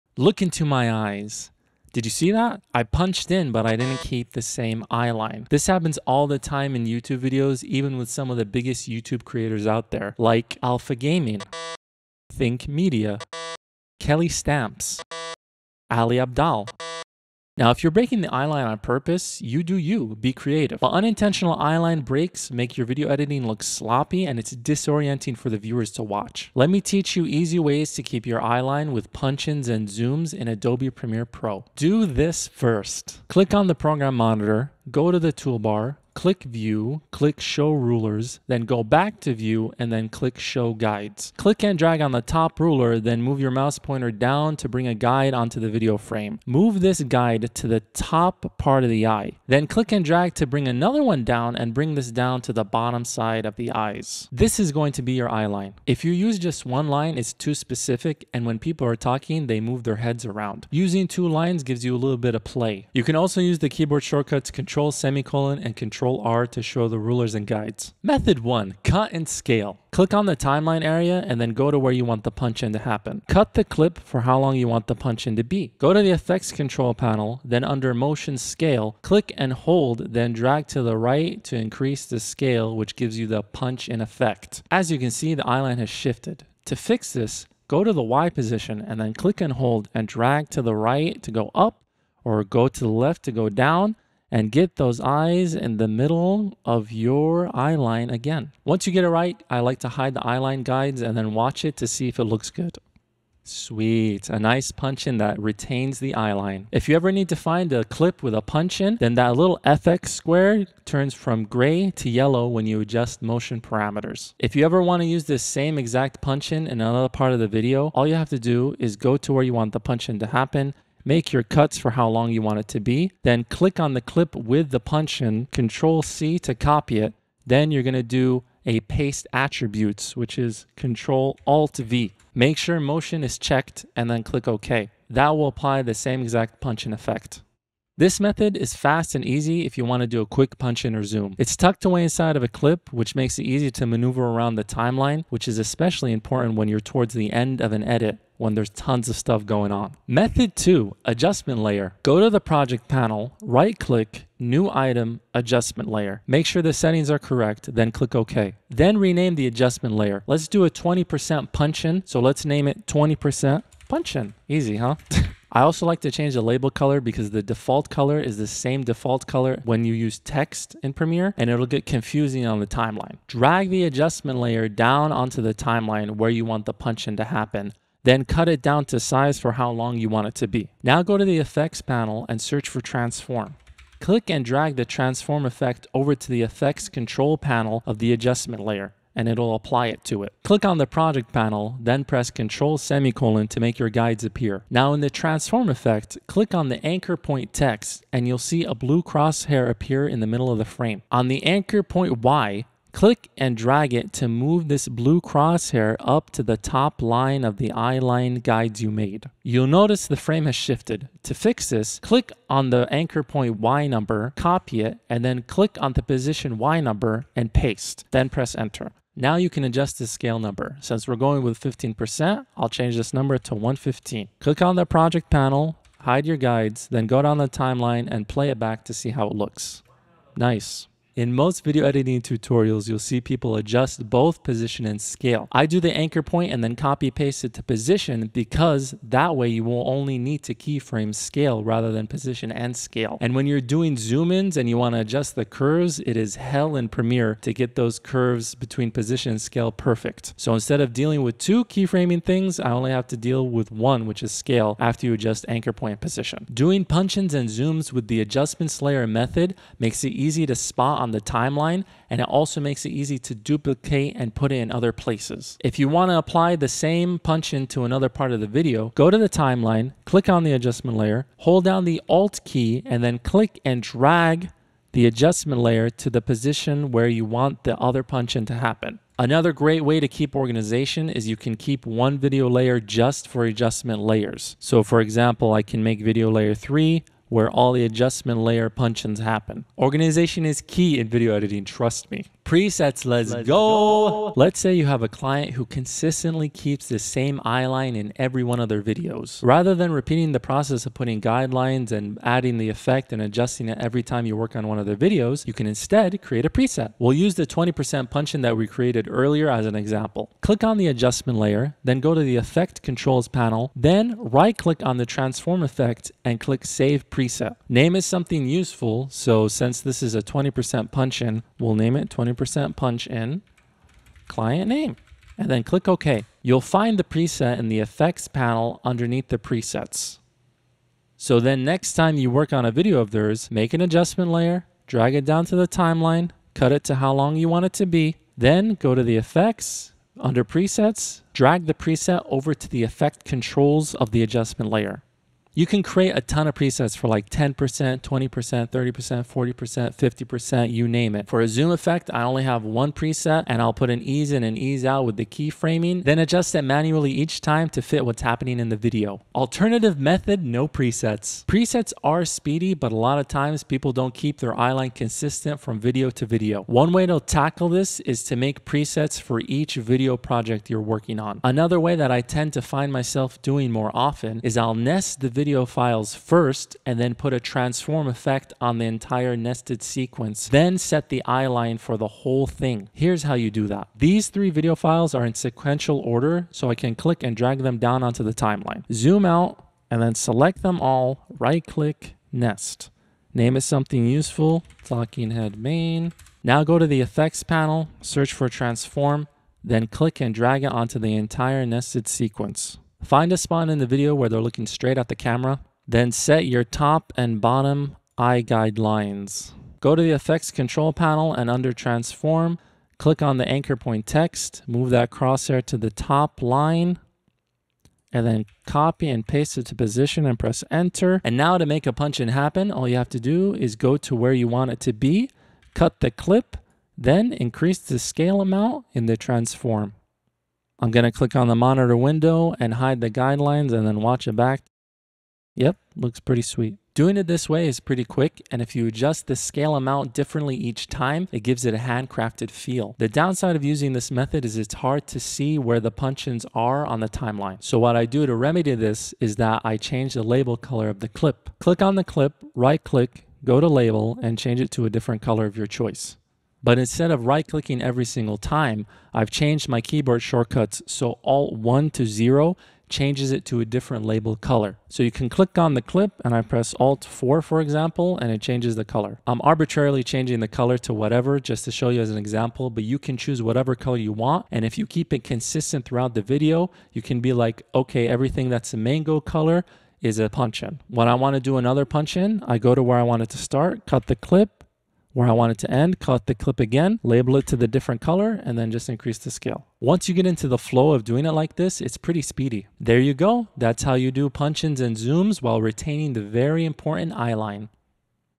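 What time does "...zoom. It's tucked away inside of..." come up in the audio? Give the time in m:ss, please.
2:21.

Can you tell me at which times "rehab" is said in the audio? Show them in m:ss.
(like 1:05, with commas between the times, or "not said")
not said.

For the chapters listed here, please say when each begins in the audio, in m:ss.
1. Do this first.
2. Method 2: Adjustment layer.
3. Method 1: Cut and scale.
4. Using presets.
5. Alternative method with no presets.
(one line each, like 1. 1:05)
1. 0:31
2. 2:30
3. 1:07
4. 4:52
5. 5:59.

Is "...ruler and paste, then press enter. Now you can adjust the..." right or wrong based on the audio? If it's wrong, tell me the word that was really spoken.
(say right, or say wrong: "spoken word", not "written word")
wrong: "number", not "ruler".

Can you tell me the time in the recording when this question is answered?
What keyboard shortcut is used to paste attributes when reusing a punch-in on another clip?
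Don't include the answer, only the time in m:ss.
2:10.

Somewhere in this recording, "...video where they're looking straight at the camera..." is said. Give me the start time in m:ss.
6:43.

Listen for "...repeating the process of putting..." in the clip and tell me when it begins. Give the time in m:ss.
4:59.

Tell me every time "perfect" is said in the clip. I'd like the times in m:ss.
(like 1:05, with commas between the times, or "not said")
4:09.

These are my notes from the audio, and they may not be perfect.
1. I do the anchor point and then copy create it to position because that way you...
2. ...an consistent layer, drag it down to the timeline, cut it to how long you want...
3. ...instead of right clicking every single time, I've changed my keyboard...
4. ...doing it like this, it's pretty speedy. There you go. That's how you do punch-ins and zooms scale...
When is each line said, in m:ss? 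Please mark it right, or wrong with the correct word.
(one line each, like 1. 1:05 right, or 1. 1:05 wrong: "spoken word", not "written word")
1. 3:55 wrong: "paste", not "create"
2. 5:33 wrong: "adjustment", not "consistent"
3. 7:36 right
4. 8:11 wrong: "while", not "scale".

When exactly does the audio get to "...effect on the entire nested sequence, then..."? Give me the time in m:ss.
6:18.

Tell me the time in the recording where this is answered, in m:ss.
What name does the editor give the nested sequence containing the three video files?
6:34.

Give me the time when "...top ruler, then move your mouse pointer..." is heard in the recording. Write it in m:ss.
0:42.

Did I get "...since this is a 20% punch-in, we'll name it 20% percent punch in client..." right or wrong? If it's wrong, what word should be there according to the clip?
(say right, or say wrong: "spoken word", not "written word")
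right.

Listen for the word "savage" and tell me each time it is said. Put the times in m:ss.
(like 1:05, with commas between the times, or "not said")
not said.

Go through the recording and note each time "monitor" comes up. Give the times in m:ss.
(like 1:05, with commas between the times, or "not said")
0:34, 7:11.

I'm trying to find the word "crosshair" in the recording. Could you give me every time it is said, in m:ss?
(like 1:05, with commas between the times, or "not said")
3:19, 3:25, 6:55.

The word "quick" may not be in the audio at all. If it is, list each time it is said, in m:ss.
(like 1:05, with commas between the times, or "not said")
2:20, 7:18.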